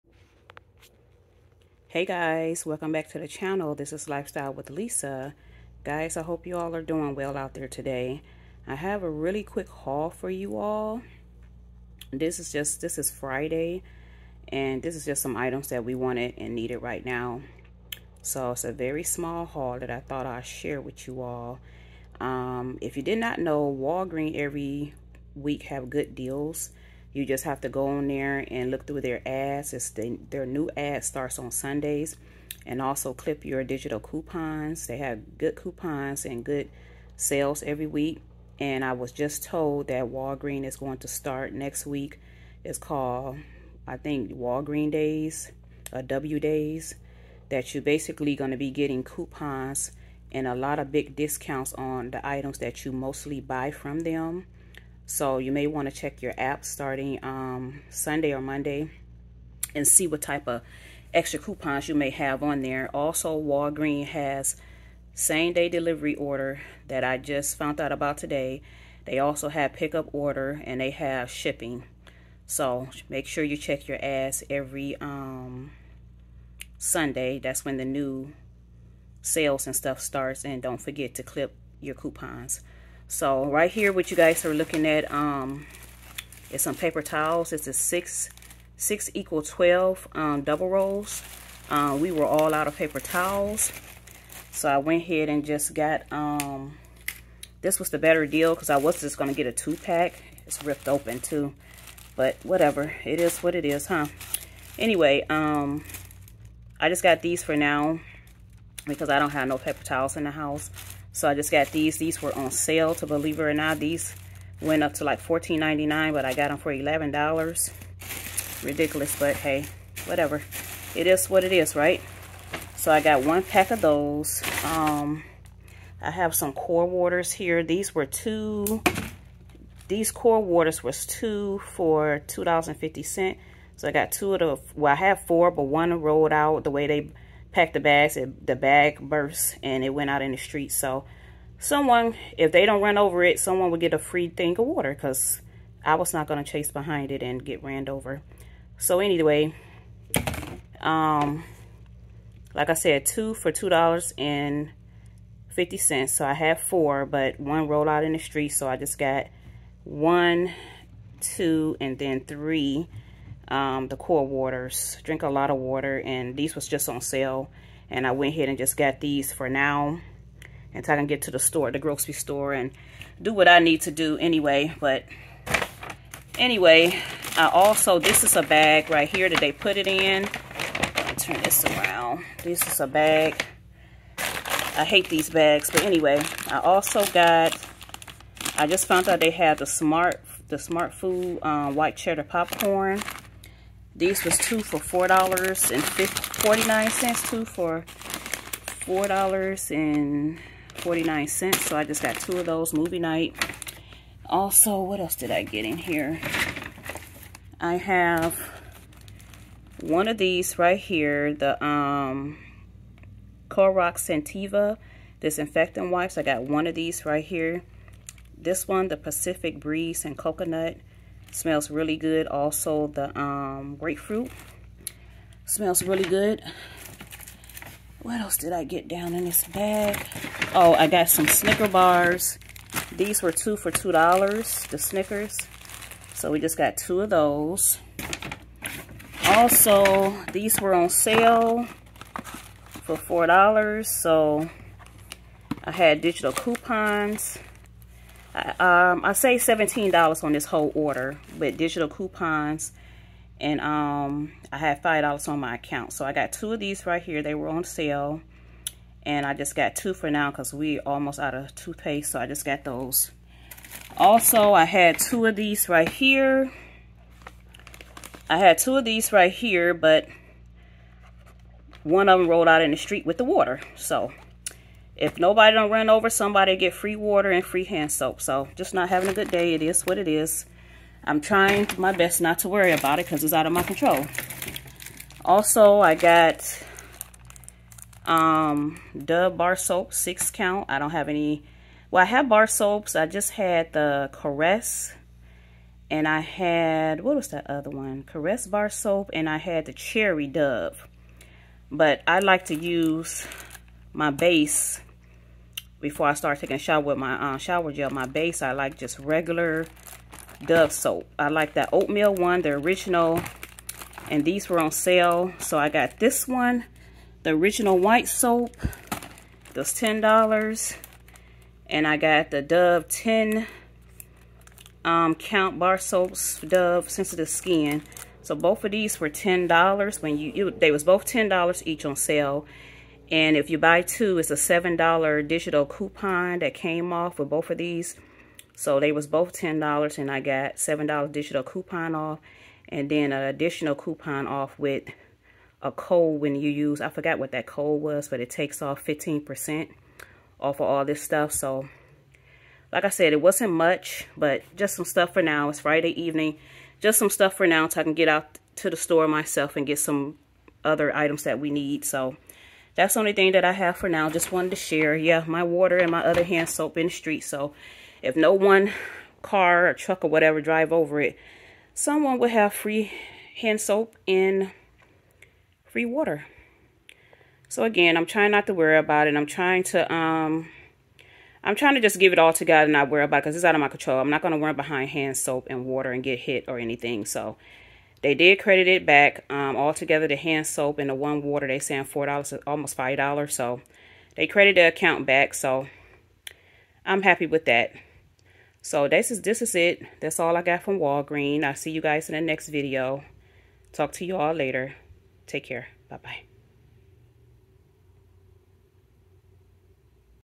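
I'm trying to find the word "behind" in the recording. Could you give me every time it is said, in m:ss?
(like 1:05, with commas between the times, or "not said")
2:26, 6:24.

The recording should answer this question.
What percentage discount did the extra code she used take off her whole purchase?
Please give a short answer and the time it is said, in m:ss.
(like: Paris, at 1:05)
15%, at 5:48.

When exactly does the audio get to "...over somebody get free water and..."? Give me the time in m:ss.
4:35.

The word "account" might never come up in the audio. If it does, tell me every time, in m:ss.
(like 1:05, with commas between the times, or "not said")
4:15, 6:34.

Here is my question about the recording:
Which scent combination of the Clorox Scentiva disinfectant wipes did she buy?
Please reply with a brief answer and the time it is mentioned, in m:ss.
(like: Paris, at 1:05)
Pacific Breeze and Coconut, at 3:38.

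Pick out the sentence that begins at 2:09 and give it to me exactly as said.
These core waters was two for $2.50.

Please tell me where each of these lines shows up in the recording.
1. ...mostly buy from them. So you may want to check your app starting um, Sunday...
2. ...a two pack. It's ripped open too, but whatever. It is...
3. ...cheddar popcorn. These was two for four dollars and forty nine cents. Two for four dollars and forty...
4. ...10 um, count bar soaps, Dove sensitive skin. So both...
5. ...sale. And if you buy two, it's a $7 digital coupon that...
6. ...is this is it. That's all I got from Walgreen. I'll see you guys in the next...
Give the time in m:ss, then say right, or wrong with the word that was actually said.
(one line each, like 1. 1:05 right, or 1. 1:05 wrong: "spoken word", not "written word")
1. 0:52 right
2. 1:39 right
3. 3:11 right
4. 5:22 right
5. 5:31 right
6. 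6:39 right.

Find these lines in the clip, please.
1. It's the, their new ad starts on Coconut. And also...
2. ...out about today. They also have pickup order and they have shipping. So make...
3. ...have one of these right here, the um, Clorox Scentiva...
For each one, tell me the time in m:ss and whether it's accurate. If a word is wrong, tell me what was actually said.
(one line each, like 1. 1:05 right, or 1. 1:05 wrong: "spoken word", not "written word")
1. 0:29 wrong: "Sundays", not "Coconut"
2. 1:07 right
3. 3:27 right.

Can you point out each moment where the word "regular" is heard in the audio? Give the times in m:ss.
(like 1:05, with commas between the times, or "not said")
5:08.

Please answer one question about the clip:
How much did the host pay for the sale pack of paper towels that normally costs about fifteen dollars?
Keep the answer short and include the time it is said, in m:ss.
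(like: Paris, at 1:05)
$11, at 1:56.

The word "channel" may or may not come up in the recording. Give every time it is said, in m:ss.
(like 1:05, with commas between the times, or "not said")
0:03.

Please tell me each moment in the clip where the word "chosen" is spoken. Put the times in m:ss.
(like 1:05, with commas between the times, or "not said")
not said.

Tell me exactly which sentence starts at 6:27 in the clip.
So they did credit it back um, altogether.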